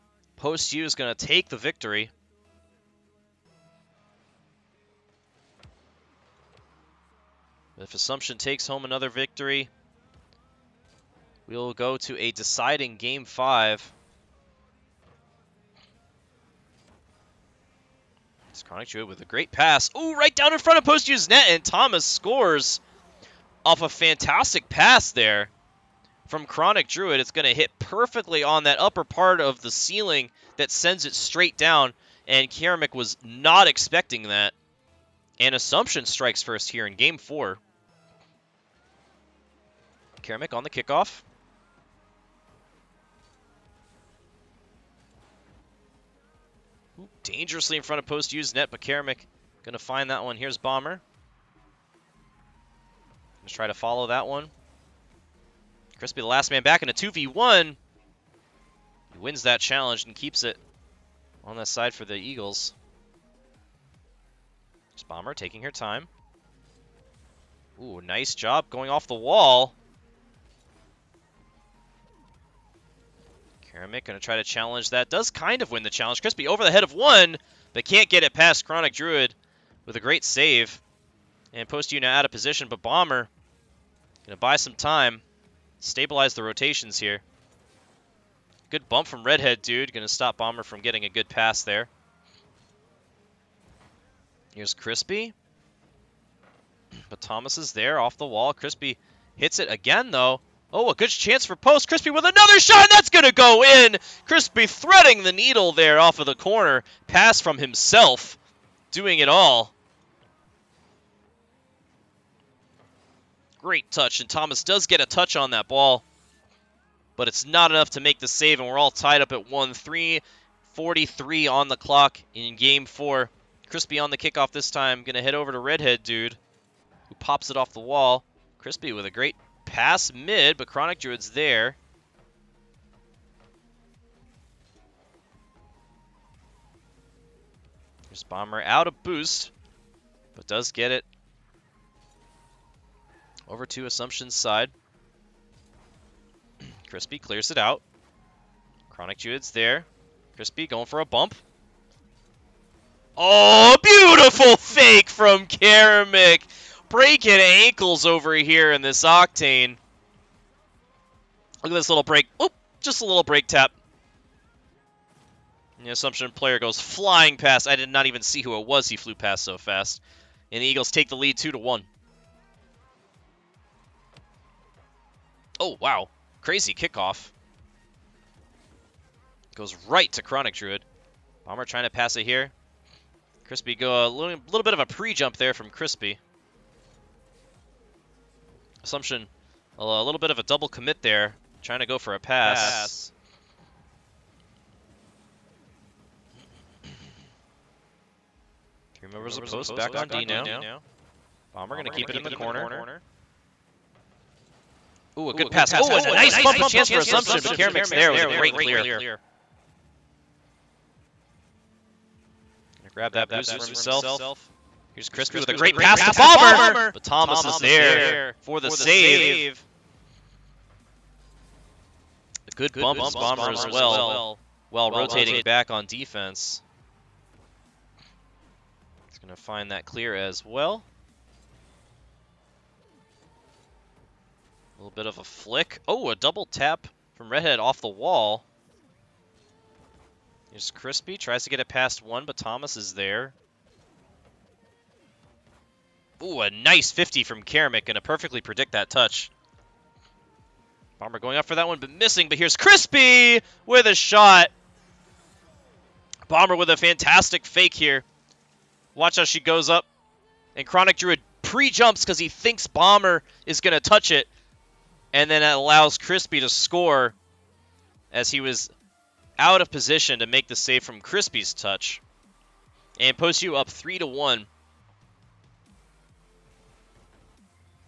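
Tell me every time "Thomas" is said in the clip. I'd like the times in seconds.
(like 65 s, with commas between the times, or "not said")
21 s, 97 s, 114 s, 217 s, 242 s.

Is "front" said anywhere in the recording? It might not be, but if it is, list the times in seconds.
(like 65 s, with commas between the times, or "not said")
20 s, 47 s.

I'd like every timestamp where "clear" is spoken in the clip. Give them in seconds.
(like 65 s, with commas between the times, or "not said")
147 s, 208 s, 229 s.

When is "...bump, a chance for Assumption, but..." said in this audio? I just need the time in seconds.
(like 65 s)
206 s.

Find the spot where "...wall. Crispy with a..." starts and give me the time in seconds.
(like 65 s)
127 s.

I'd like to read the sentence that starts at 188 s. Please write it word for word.
Assumption, a, a little bit of a double commit there, trying to go for a pass.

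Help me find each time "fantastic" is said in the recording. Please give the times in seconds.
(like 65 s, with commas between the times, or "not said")
23 s, 256 s.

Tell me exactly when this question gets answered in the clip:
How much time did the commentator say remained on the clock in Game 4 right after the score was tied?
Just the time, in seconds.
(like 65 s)
120 s.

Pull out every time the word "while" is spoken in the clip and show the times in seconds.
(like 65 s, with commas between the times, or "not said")
224 s.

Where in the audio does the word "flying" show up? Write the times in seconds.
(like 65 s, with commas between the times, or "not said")
166 s.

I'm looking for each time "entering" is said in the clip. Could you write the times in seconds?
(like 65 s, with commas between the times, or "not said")
not said.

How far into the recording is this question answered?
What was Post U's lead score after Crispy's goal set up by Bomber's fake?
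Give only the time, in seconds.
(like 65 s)
273 s.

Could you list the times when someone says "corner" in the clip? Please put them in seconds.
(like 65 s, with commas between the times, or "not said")
106 s, 202 s.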